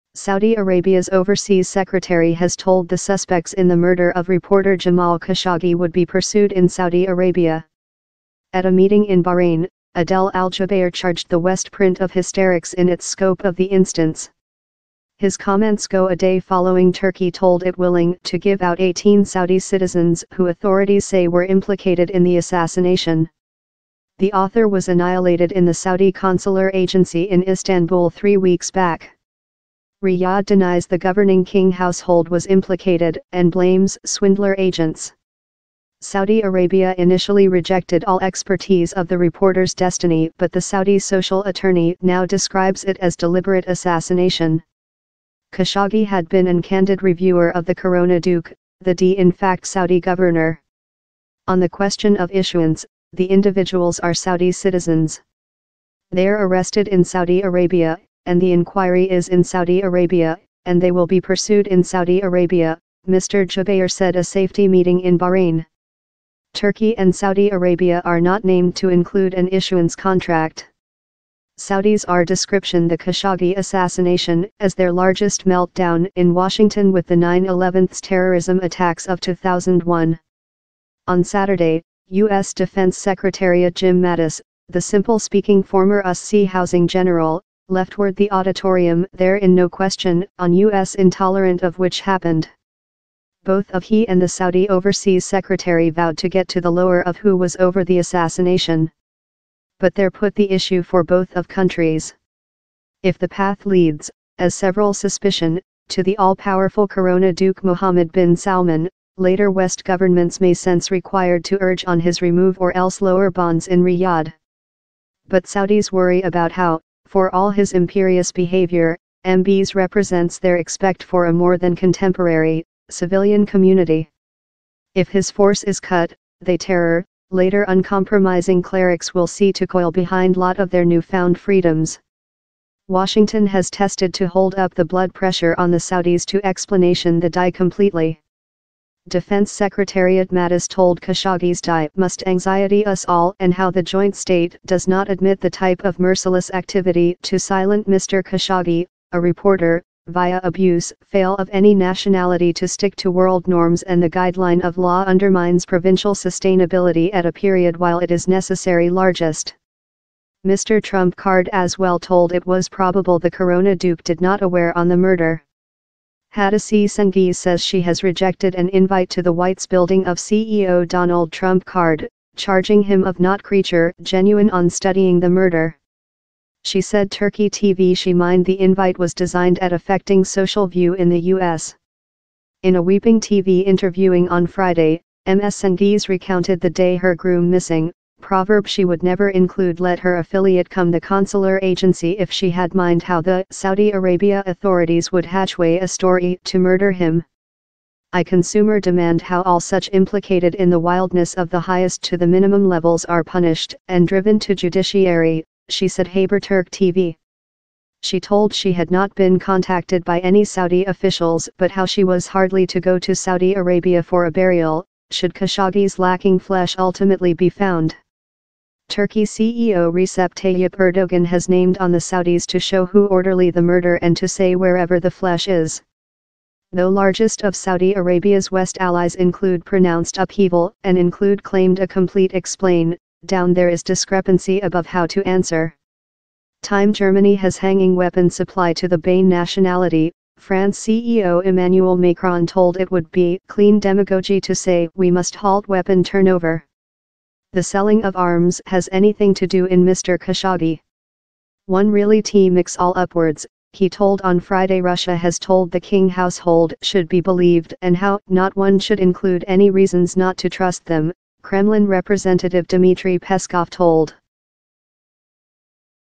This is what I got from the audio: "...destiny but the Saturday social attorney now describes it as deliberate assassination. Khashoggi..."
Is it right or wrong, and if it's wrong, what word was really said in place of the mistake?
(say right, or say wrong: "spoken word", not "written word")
wrong: "Saudi", not "Saturday".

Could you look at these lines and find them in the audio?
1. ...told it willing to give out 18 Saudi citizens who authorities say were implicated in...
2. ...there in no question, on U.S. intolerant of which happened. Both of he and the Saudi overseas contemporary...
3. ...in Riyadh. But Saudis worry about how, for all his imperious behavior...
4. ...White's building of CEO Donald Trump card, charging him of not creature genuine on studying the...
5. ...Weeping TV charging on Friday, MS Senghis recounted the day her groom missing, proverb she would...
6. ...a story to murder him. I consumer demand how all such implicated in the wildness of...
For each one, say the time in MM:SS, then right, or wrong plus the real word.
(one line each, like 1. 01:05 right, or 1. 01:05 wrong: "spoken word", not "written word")
1. 00:17 right
2. 01:29 wrong: "secretary", not "contemporary"
3. 01:53 right
4. 02:49 right
5. 03:02 wrong: "interviewing", not "charging"
6. 03:15 right.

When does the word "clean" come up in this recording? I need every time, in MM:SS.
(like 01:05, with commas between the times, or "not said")
04:03.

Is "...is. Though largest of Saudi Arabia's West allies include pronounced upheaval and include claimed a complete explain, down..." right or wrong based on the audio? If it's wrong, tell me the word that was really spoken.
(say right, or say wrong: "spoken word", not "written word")
right.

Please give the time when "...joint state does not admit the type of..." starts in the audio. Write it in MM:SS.
02:23.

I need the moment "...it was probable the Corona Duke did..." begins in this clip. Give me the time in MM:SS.
02:42.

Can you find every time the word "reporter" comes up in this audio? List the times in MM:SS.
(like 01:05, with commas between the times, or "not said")
00:04, 00:39, 02:29.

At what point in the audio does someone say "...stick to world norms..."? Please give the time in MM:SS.
02:32.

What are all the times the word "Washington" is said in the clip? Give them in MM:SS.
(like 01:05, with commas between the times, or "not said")
01:16, 02:12.